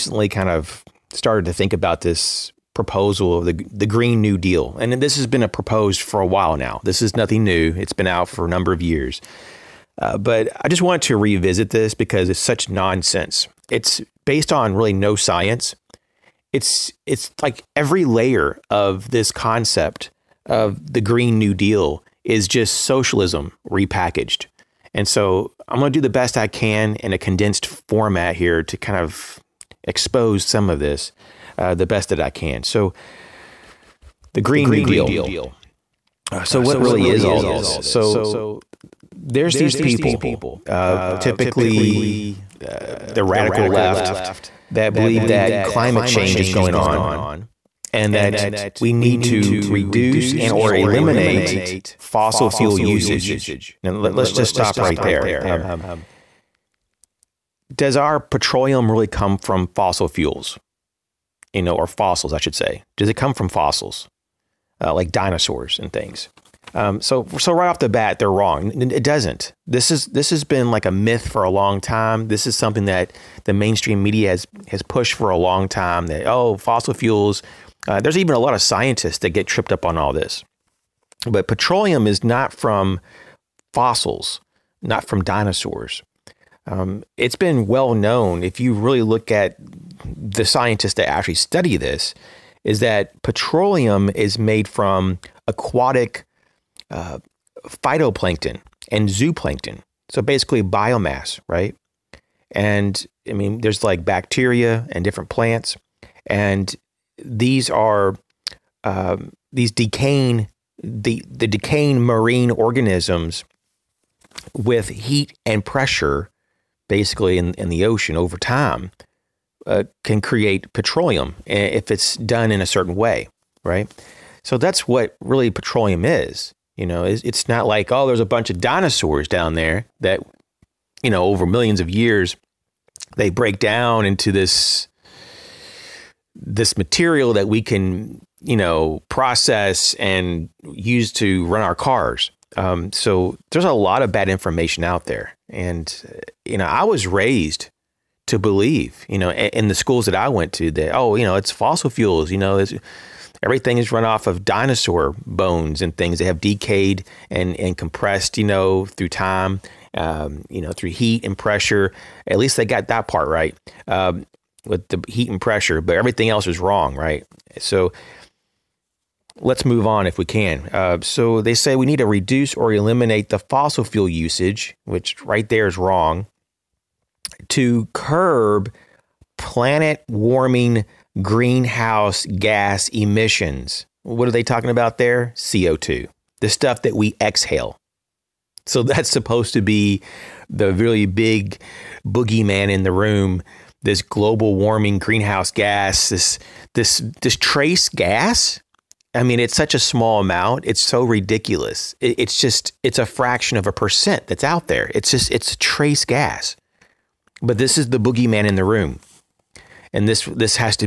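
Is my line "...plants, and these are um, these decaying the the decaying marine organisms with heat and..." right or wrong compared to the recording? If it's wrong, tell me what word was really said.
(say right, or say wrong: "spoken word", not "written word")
right.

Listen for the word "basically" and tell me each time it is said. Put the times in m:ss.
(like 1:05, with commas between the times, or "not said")
1:40, 1:56.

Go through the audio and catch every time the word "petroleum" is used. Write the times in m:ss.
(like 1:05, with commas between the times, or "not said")
0:58, 1:21, 1:33, 2:00, 2:05.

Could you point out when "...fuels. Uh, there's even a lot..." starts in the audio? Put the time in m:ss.
1:16.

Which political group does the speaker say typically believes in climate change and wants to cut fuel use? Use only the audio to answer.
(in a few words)
the radical left.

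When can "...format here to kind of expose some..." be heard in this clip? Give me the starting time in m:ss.
0:27.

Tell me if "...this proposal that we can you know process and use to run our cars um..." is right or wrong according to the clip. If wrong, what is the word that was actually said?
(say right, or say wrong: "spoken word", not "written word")
wrong: "material", not "proposal".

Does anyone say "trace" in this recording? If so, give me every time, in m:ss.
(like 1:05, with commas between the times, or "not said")
3:17, 3:25.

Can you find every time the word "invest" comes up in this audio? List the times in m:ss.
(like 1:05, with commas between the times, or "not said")
not said.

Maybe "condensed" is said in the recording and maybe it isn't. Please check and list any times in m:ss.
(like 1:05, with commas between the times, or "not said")
0:27.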